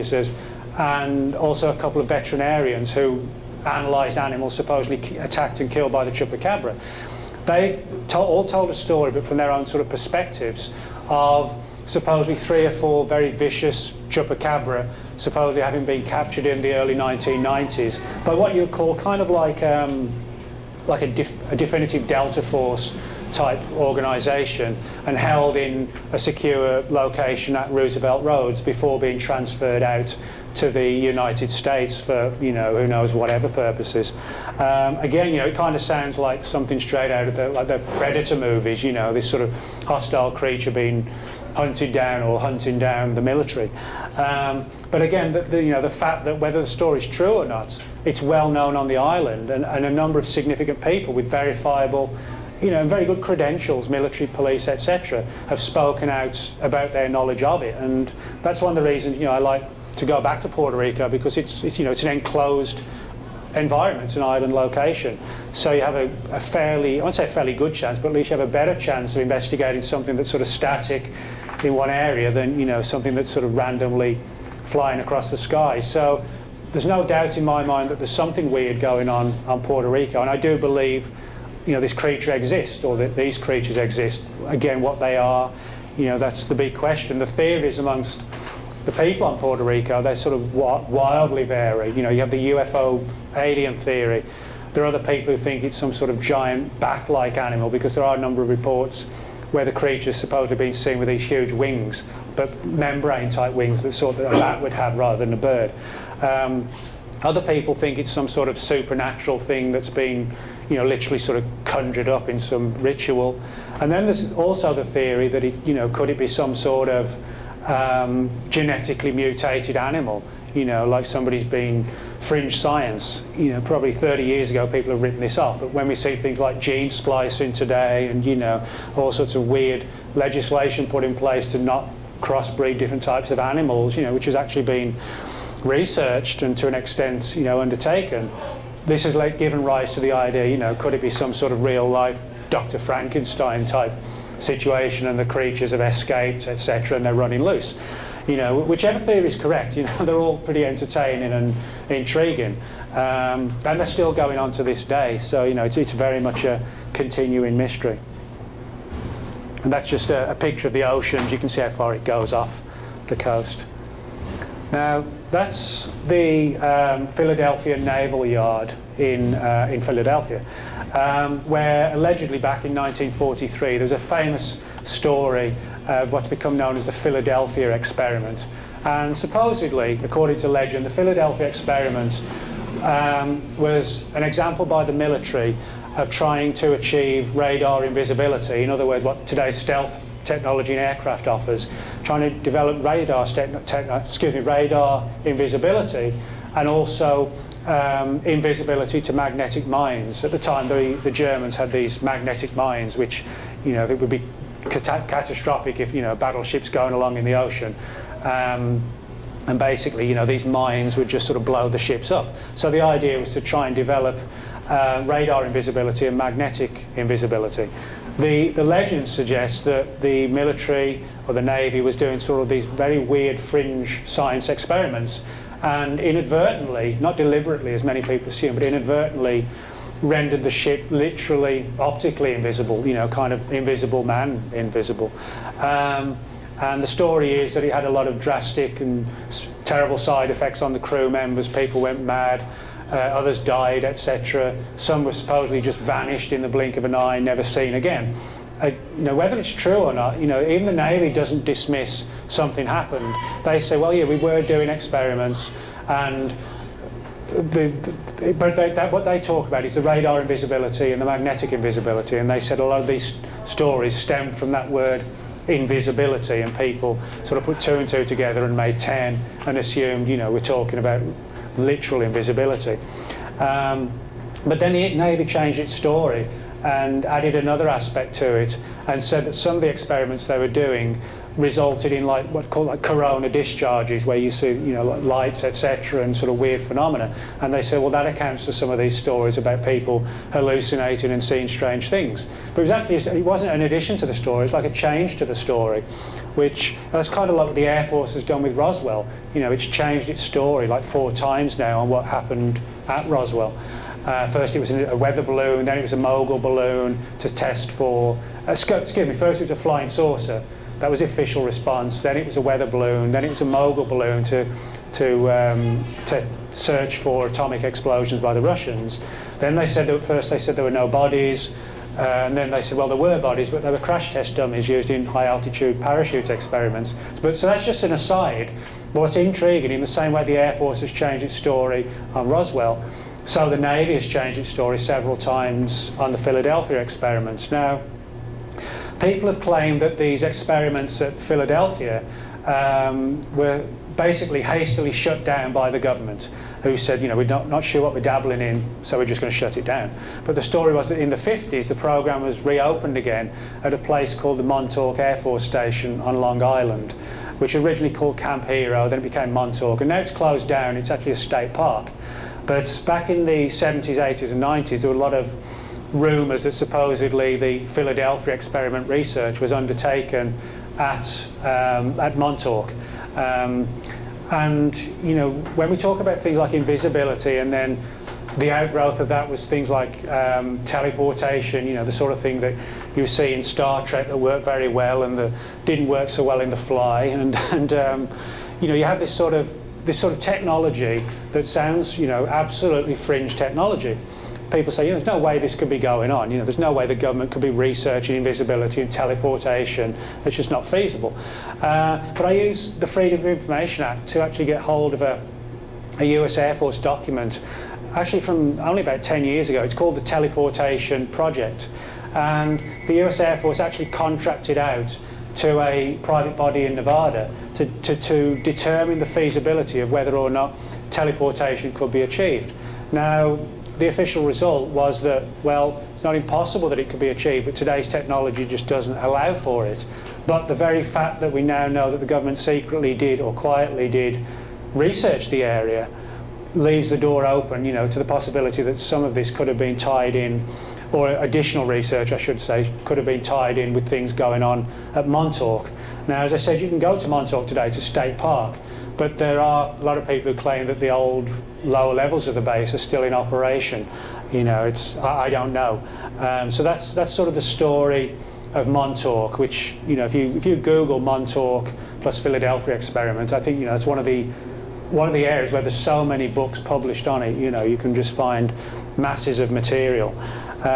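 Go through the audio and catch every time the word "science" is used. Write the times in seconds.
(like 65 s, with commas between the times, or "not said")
122 s, 224 s.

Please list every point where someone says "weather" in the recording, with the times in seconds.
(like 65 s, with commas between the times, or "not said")
304 s, 312 s.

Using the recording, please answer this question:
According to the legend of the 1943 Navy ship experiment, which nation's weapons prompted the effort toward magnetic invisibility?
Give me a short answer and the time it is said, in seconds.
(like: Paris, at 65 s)
The Germans, at 201 s.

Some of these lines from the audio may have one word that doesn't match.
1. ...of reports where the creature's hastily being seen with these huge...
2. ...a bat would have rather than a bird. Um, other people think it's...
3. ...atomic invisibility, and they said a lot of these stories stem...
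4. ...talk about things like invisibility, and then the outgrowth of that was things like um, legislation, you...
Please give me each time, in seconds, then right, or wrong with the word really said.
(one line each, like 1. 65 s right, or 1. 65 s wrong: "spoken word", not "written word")
1. 98 s wrong: "supposedly", not "hastily"
2. 104 s right
3. 261 s wrong: "magnetic", not "atomic"
4. 375 s wrong: "teleportation", not "legislation".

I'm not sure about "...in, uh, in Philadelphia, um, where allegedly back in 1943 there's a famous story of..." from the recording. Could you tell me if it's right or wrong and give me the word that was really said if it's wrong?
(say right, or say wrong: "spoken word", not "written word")
right.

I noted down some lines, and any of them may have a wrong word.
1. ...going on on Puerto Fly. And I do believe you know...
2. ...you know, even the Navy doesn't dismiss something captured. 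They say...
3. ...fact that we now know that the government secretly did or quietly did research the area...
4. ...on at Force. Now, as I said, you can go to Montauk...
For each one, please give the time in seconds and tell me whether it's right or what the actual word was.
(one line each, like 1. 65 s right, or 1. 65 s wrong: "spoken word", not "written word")
1. 78 s wrong: "Rico", not "Fly"
2. 250 s wrong: "happened", not "captured"
3. 430 s right
4. 444 s wrong: "Montauk", not "Force".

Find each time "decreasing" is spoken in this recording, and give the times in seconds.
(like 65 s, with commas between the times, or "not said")
not said.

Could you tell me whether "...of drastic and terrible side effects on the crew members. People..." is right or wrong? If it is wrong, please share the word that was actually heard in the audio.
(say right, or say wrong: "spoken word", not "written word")
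right.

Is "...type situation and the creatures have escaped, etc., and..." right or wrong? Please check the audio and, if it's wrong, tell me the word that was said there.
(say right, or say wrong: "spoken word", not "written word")
right.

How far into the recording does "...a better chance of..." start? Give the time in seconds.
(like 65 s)
68 s.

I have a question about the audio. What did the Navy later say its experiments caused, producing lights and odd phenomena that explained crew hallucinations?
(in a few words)
Corona discharges.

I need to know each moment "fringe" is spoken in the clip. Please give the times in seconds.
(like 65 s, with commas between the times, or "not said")
122 s, 223 s, 392 s.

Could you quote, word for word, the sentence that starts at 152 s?
Um, and they're still going on to this day, so, you know, it's, it's very much a continuing mystery.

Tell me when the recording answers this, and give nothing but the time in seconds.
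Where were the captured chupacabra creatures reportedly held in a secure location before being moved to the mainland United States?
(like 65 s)
27 s.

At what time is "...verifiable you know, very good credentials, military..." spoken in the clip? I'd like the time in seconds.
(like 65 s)
51 s.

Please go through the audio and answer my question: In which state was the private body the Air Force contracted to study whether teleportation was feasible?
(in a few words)
Nevada.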